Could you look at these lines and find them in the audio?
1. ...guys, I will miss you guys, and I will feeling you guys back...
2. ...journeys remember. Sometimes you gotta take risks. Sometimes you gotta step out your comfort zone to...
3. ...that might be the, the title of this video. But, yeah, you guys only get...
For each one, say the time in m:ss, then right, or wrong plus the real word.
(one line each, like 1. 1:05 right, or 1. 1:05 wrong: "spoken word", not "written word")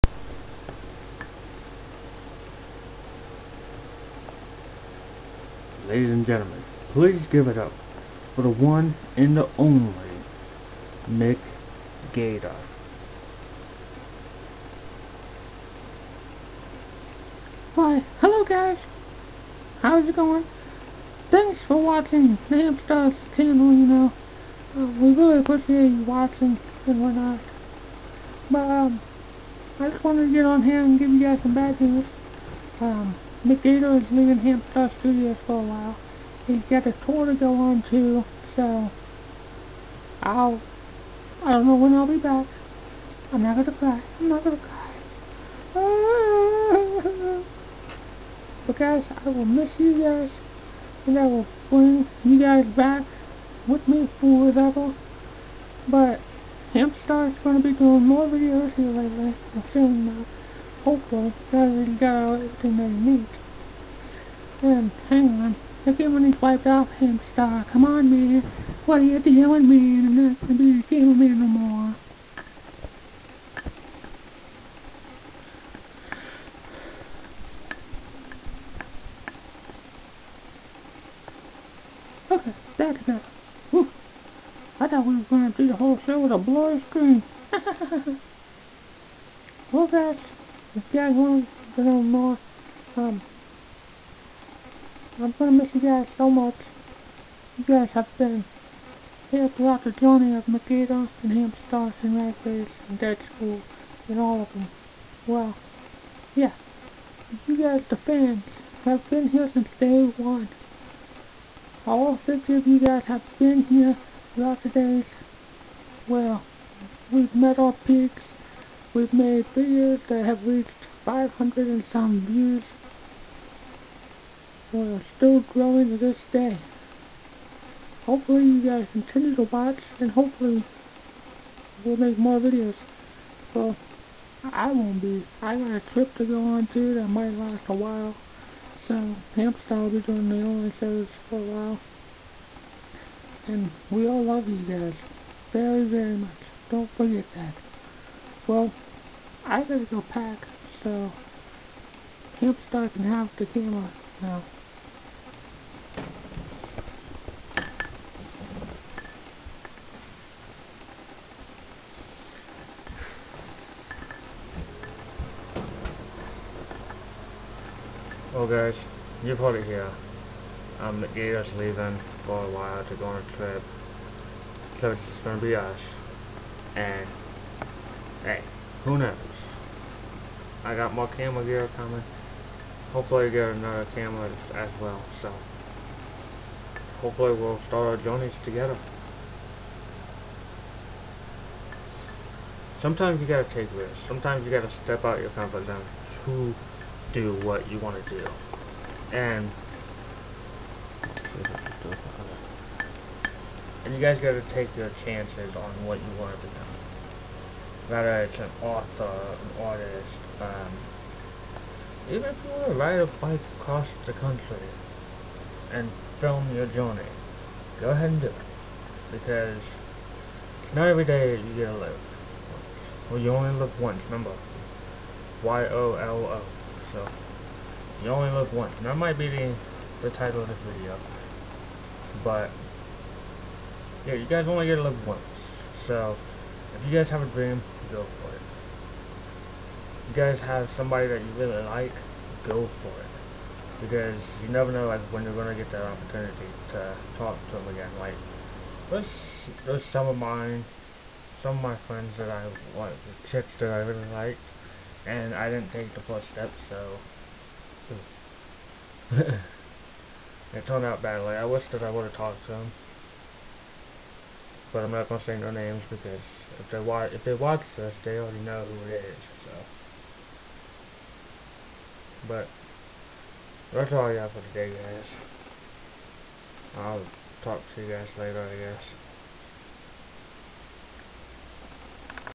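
1. 0:48 wrong: "bring", not "feeling"
2. 3:08 wrong: "together", not "remember"
3. 3:48 right.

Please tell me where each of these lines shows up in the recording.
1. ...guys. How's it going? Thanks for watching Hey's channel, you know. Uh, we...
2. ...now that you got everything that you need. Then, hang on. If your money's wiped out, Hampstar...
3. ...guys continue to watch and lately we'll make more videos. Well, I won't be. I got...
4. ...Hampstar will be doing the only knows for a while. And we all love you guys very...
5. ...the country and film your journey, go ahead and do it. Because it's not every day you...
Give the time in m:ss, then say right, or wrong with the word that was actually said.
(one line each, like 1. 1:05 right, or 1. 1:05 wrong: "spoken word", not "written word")
1. 0:18 wrong: "Hampstar", not "Hey"
2. 1:01 right
3. 2:08 wrong: "hopefully", not "lately"
4. 2:19 wrong: "shows", not "knows"
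5. 3:34 right.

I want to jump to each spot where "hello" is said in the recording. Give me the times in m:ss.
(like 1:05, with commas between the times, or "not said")
0:18.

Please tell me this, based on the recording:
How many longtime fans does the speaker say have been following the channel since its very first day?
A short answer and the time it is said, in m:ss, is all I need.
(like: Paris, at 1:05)
50, at 1:52.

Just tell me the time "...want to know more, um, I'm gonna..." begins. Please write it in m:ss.
1:31.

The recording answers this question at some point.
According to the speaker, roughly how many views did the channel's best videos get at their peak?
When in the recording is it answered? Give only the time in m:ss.
2:01.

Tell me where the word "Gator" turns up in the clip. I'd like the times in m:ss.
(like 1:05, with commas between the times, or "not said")
0:12, 0:33, 2:51.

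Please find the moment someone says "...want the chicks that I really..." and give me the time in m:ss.
4:12.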